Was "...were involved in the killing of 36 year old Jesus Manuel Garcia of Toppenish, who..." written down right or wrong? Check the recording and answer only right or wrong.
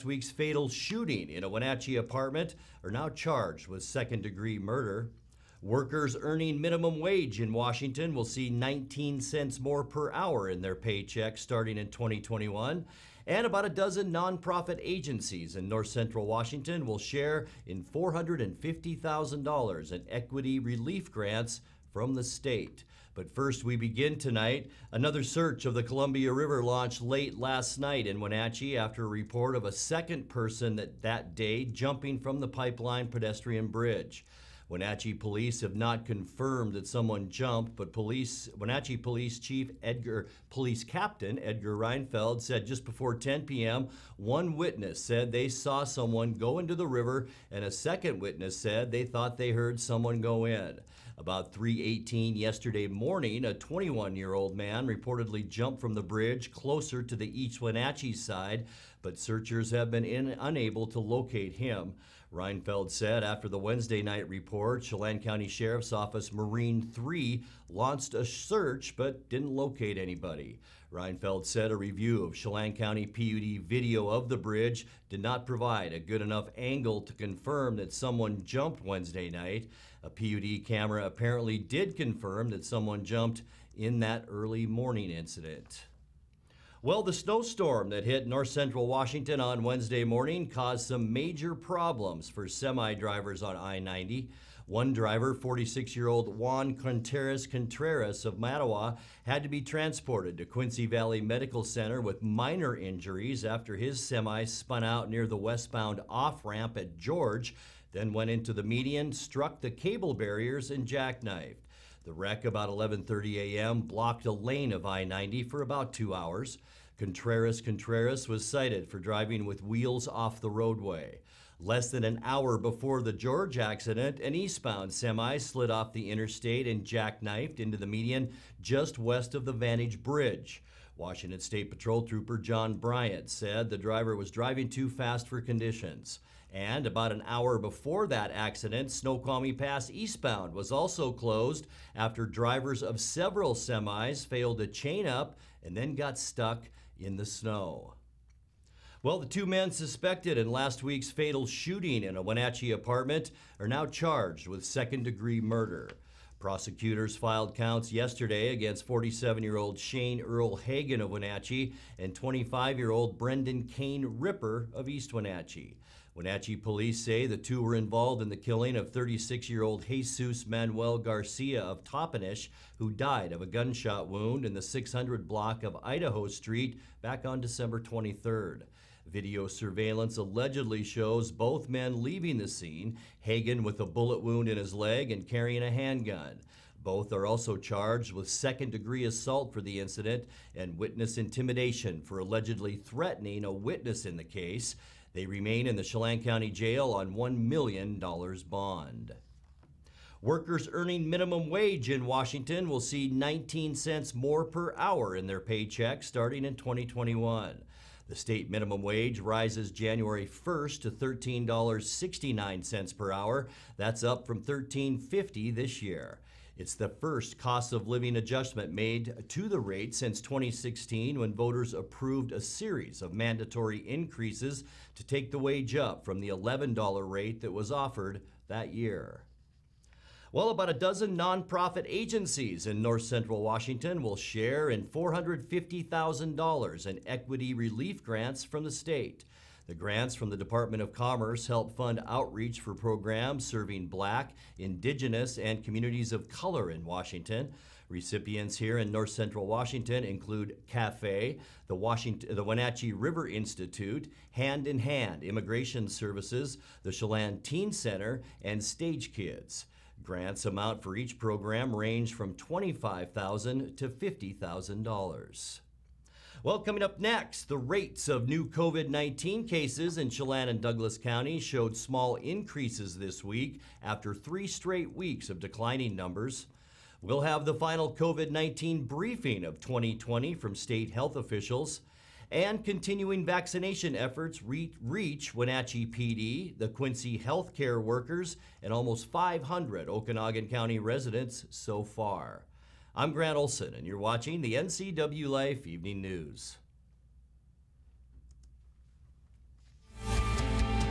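right.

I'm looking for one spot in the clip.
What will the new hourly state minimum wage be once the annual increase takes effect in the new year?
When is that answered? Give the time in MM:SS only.
03:30.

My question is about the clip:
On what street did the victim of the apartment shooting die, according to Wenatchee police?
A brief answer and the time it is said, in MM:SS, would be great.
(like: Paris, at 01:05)
Idaho Street, at 02:55.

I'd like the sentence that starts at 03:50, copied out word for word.
Well, about a dozen nonprofit agencies in north central Washington will share in $450,000 in equity relief grants from the state.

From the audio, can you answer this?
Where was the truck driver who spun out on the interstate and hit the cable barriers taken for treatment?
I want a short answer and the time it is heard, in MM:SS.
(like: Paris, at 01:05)
Quincy Valley Medical Center, at 01:40.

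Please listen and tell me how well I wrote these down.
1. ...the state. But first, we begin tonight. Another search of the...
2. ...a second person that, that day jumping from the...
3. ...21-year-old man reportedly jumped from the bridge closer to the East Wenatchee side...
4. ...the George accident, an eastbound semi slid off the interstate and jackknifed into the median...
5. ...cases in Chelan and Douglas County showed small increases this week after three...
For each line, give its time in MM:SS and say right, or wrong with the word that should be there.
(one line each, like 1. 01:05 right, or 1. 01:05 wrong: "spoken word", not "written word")
1. 00:22 right
2. 00:29 right
3. 00:53 right
4. 02:03 right
5. 04:29 right.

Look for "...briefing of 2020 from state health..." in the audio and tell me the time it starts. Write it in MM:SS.
04:38.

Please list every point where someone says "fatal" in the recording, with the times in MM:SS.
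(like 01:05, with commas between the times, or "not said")
00:00, 02:31.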